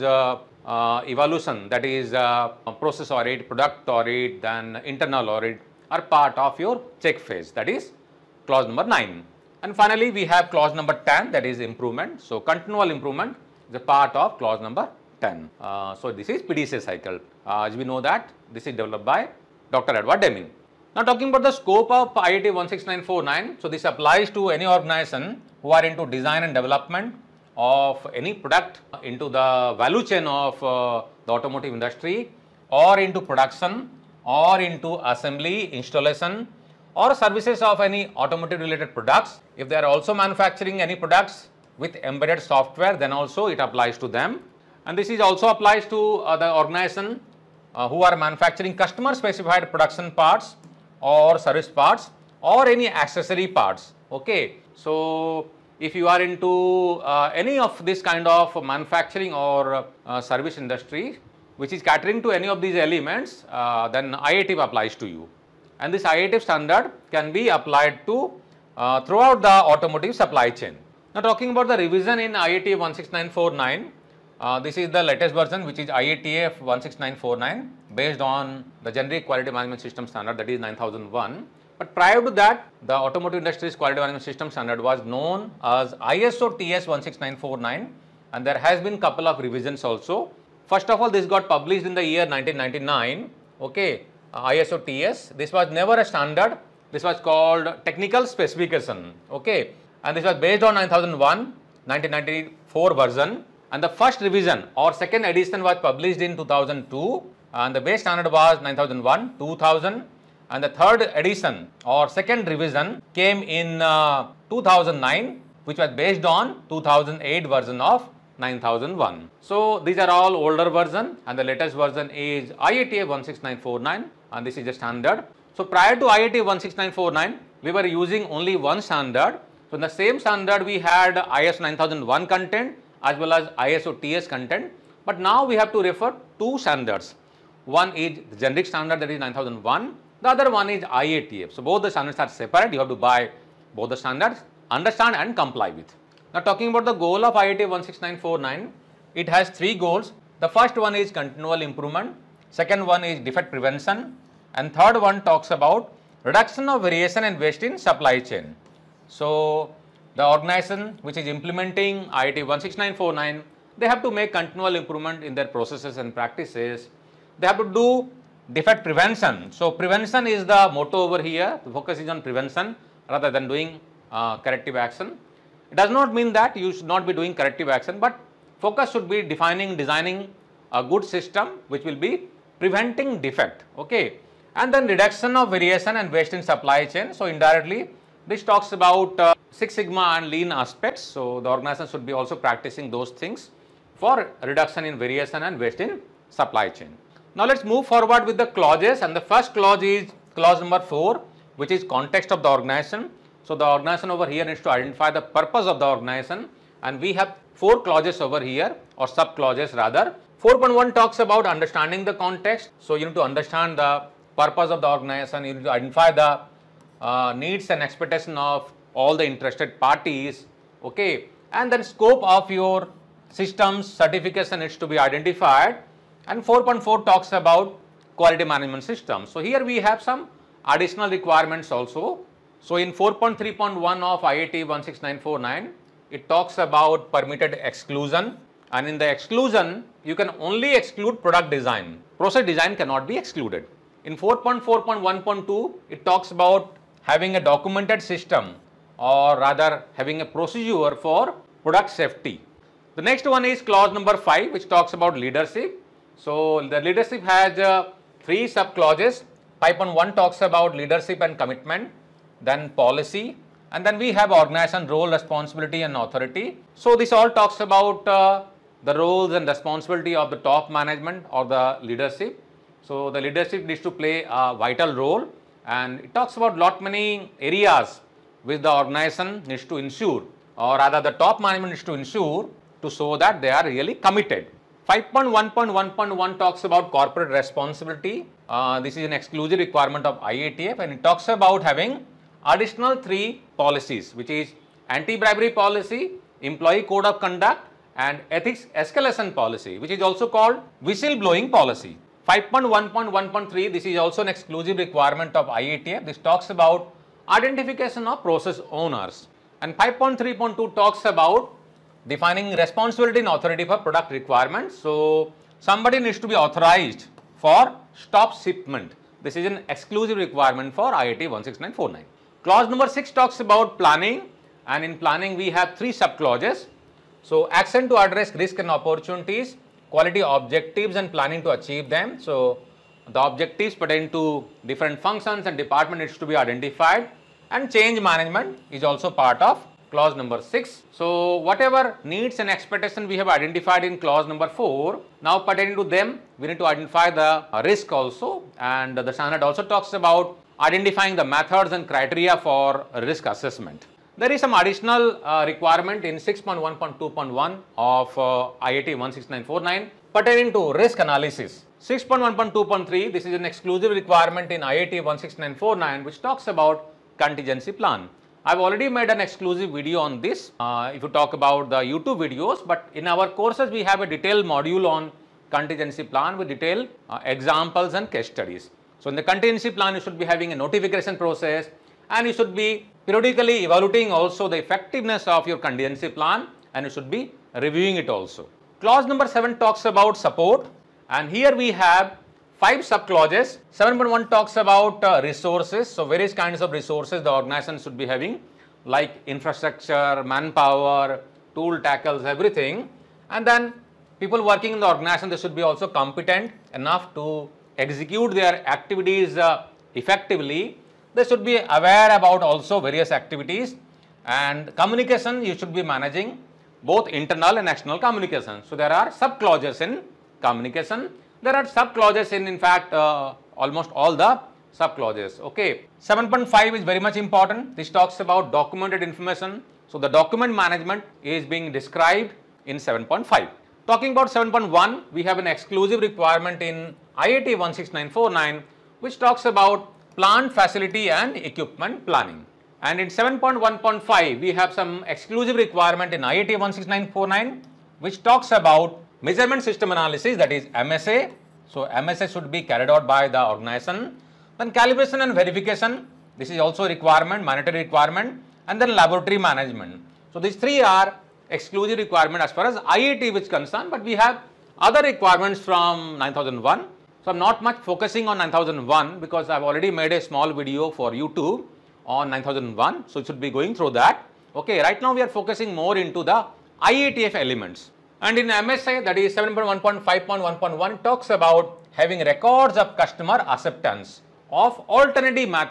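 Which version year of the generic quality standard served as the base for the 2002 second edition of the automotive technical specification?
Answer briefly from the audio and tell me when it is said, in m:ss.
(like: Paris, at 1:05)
2000, at 1:48.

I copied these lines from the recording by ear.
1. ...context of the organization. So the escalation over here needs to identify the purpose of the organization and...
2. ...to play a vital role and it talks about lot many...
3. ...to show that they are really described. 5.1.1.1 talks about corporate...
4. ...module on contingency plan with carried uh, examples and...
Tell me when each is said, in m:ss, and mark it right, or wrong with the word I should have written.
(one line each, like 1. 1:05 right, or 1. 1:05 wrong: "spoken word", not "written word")
1. 3:21 wrong: "organization", not "escalation"
2. 4:33 right
3. 4:42 wrong: "committed", not "described"
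4. 6:14 wrong: "detailed", not "carried".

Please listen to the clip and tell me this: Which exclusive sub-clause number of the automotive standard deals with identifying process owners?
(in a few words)
5.1.1.3.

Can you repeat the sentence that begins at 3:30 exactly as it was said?
4.1 talks about understanding the context.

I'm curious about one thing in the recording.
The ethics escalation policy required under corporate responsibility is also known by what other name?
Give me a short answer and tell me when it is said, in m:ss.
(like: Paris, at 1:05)
Whistleblowing policy, at 5:00.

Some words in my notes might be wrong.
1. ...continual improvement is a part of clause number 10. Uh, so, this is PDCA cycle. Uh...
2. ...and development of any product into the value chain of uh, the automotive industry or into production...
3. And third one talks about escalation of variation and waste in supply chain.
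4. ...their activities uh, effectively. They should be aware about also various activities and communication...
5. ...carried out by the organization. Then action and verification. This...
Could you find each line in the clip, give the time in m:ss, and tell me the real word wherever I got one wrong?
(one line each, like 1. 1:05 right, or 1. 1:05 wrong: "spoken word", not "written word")
1. 0:12 right
2. 0:26 right
3. 2:34 wrong: "reduction", not "escalation"
4. 6:48 right
5. 7:32 wrong: "calibration", not "action".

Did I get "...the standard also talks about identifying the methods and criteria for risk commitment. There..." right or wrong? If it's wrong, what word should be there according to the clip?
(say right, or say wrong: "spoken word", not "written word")
wrong: "assessment", not "commitment".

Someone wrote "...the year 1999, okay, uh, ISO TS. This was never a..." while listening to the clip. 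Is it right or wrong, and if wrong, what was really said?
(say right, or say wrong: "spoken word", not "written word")
right.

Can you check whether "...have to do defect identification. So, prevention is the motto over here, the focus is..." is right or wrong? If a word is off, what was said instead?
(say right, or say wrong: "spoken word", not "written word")
wrong: "prevention", not "identification".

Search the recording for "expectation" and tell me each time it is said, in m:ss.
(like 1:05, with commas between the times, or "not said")
3:37, 5:42.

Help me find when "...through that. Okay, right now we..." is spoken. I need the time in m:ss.
7:53.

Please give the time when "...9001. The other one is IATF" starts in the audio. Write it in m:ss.
2:19.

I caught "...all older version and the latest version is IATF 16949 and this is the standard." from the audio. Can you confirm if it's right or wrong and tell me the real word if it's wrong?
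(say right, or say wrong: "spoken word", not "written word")
right.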